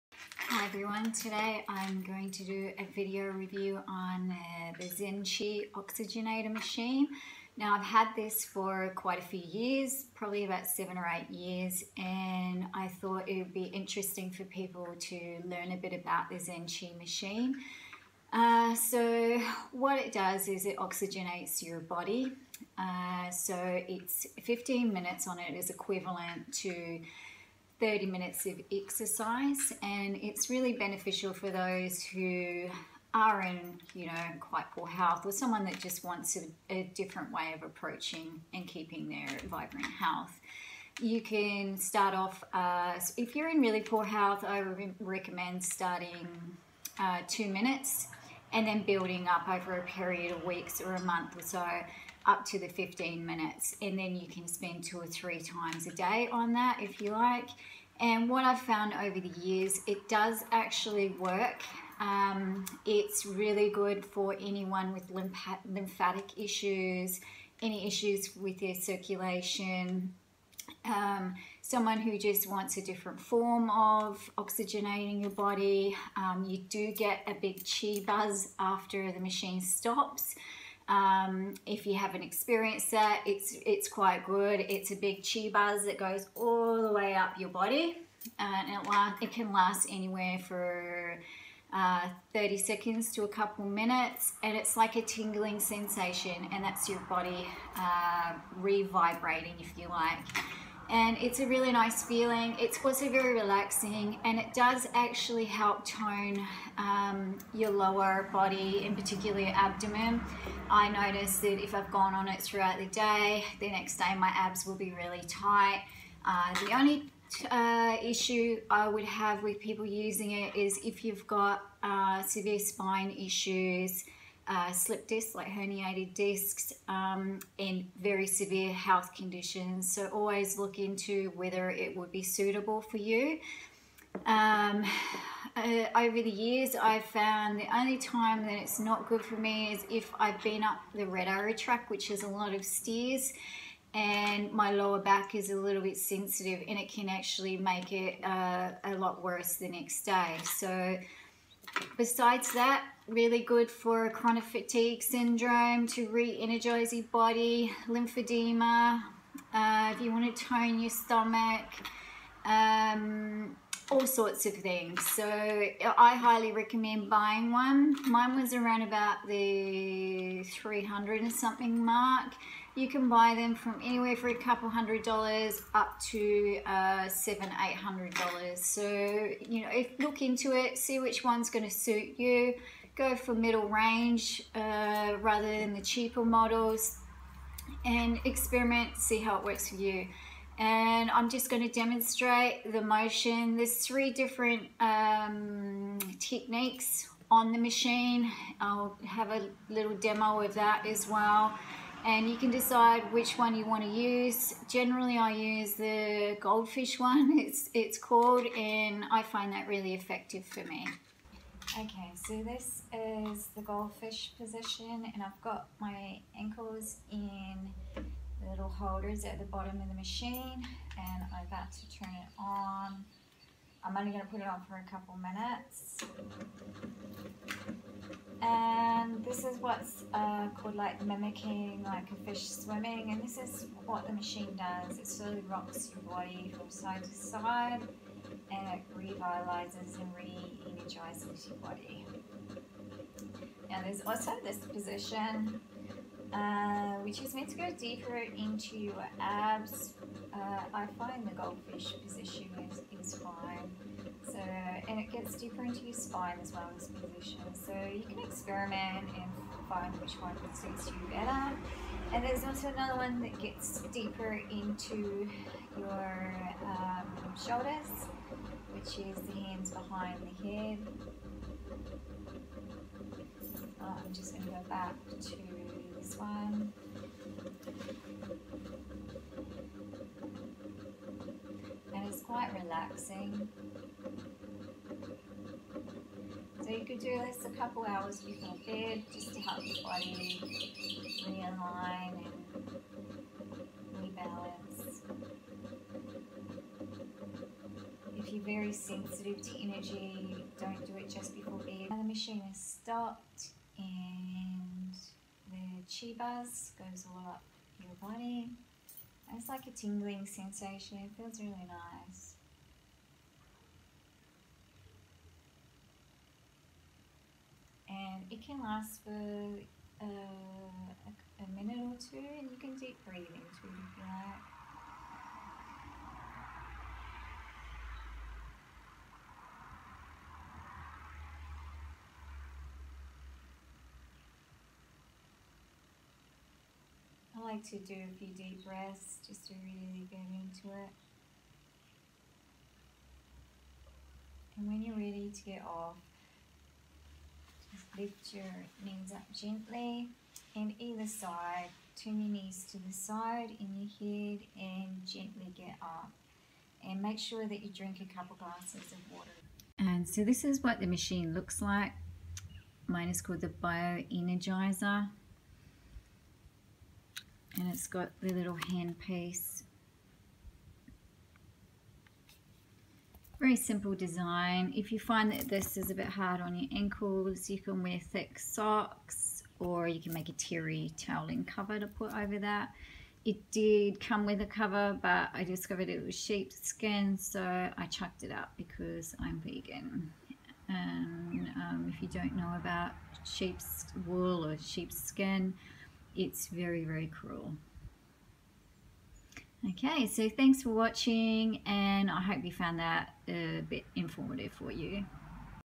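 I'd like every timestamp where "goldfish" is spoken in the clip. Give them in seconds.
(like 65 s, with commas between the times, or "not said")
206 s, 213 s, 251 s.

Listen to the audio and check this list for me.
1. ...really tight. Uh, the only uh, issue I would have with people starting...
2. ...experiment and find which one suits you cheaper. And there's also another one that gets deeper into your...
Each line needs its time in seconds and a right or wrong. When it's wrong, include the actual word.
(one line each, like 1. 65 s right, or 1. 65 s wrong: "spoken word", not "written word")
1. 114 s wrong: "using", not "starting"
2. 258 s wrong: "better", not "cheaper".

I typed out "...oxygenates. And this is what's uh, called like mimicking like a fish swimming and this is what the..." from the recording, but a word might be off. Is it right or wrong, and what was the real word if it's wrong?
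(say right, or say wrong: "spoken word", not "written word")
wrong: "minutes", not "oxygenates".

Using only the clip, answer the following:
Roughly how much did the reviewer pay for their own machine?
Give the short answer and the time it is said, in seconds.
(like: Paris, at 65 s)
300 and something, at 170 s.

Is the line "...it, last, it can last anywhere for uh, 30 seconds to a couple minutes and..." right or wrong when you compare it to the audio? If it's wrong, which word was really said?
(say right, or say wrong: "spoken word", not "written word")
right.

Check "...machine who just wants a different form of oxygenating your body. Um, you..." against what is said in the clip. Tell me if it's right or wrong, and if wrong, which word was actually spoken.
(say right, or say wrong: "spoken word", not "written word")
wrong: "someone", not "machine".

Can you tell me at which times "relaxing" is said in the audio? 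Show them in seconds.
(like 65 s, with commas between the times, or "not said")
103 s, 282 s.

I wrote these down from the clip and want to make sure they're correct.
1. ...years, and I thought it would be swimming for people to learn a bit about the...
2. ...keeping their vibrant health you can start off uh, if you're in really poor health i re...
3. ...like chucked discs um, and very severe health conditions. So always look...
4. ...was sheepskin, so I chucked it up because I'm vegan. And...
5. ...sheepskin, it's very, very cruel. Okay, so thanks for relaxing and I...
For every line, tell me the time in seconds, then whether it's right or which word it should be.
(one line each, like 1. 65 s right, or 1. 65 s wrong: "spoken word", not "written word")
1. 11 s wrong: "interesting", not "swimming"
2. 38 s right
3. 125 s wrong: "herniated", not "chucked"
4. 386 s right
5. 394 s wrong: "watching", not "relaxing".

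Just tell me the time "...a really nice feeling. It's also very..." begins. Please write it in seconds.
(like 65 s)
101 s.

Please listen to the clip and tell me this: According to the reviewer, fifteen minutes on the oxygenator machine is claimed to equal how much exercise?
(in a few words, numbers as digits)
30 minutes.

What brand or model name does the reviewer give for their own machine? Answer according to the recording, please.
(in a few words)
Bio Energizer.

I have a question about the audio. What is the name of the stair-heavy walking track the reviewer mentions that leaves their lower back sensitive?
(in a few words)
Red Arrow track.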